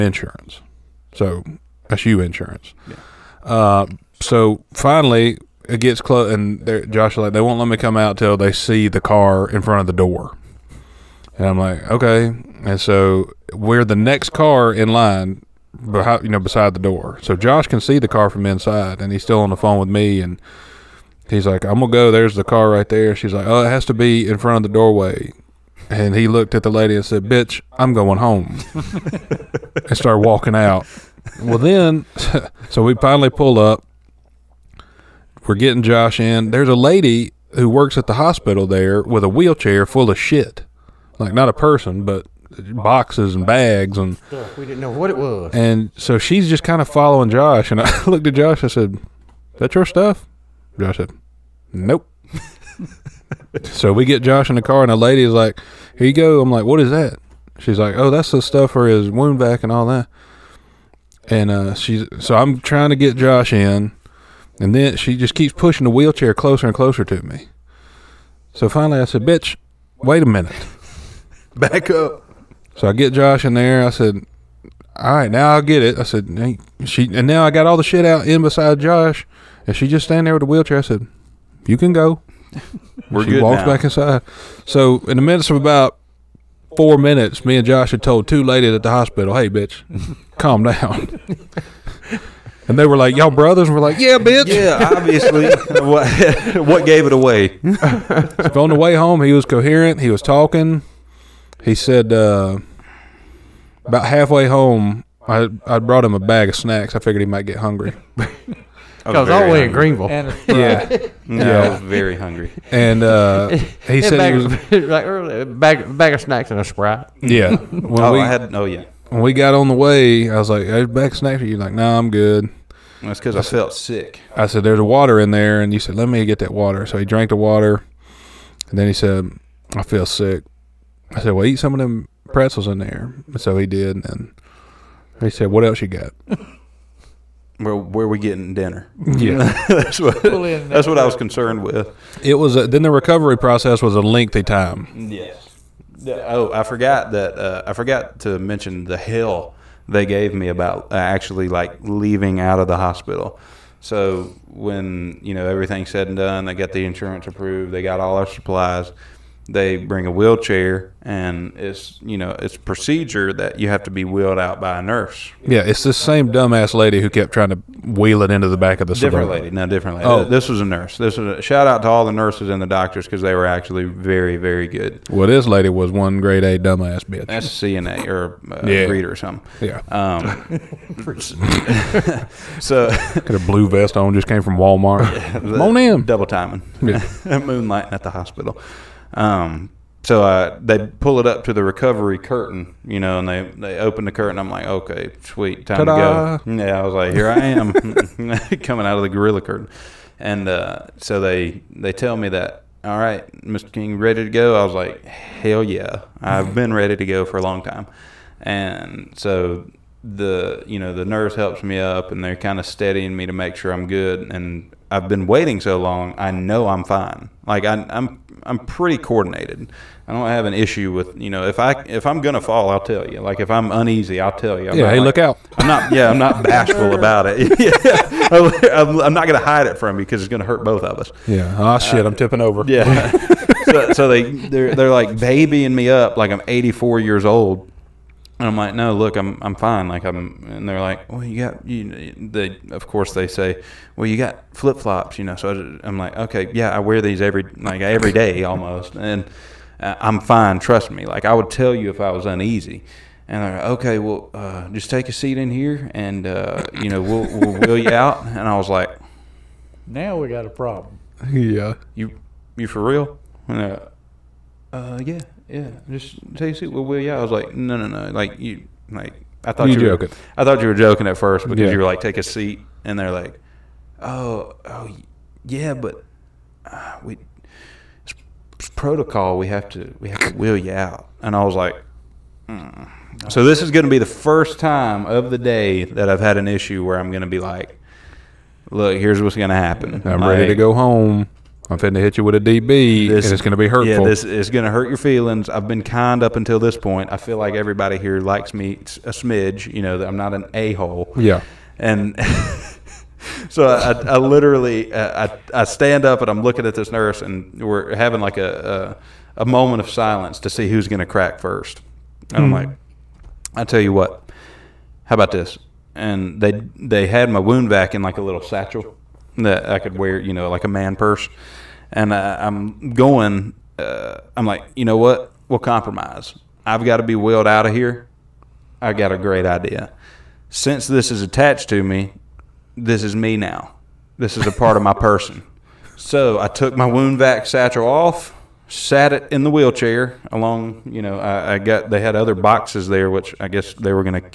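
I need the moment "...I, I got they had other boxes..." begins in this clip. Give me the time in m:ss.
5:41.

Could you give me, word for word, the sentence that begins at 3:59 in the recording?
Like I'm, and they're like, well, you got you.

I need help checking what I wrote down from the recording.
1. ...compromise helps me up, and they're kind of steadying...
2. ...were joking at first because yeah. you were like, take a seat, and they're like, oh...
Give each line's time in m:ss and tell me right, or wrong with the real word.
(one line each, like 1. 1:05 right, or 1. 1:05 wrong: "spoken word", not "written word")
1. 3:31 wrong: "nurse", not "compromise"
2. 4:30 right.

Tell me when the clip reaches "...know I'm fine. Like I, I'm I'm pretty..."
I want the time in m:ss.
3:36.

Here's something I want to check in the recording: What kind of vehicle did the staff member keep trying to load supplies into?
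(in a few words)
Suburban.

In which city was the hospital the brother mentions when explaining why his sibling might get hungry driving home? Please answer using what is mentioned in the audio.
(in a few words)
Greenville.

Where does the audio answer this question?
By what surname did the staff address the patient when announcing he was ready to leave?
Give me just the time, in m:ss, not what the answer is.
3:23.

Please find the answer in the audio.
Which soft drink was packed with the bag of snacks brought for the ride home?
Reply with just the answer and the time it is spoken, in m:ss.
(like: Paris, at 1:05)
Sprite, at 1:56.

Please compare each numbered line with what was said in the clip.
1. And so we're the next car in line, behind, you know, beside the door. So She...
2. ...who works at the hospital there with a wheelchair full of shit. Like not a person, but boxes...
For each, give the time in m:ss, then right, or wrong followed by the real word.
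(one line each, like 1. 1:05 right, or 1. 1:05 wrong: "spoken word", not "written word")
1. 0:12 wrong: "Josh", not "She"
2. 0:37 right.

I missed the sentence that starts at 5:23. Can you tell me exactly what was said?
Uh, I'm like, you know what?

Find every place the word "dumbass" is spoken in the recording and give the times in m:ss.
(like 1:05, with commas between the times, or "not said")
2:46, 2:56.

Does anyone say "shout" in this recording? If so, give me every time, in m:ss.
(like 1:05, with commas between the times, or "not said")
2:51.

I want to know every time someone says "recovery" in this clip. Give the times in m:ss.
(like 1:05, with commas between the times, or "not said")
2:22, 3:11.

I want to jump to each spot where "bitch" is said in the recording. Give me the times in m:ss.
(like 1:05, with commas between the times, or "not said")
0:27, 1:09, 1:29, 1:34, 2:57.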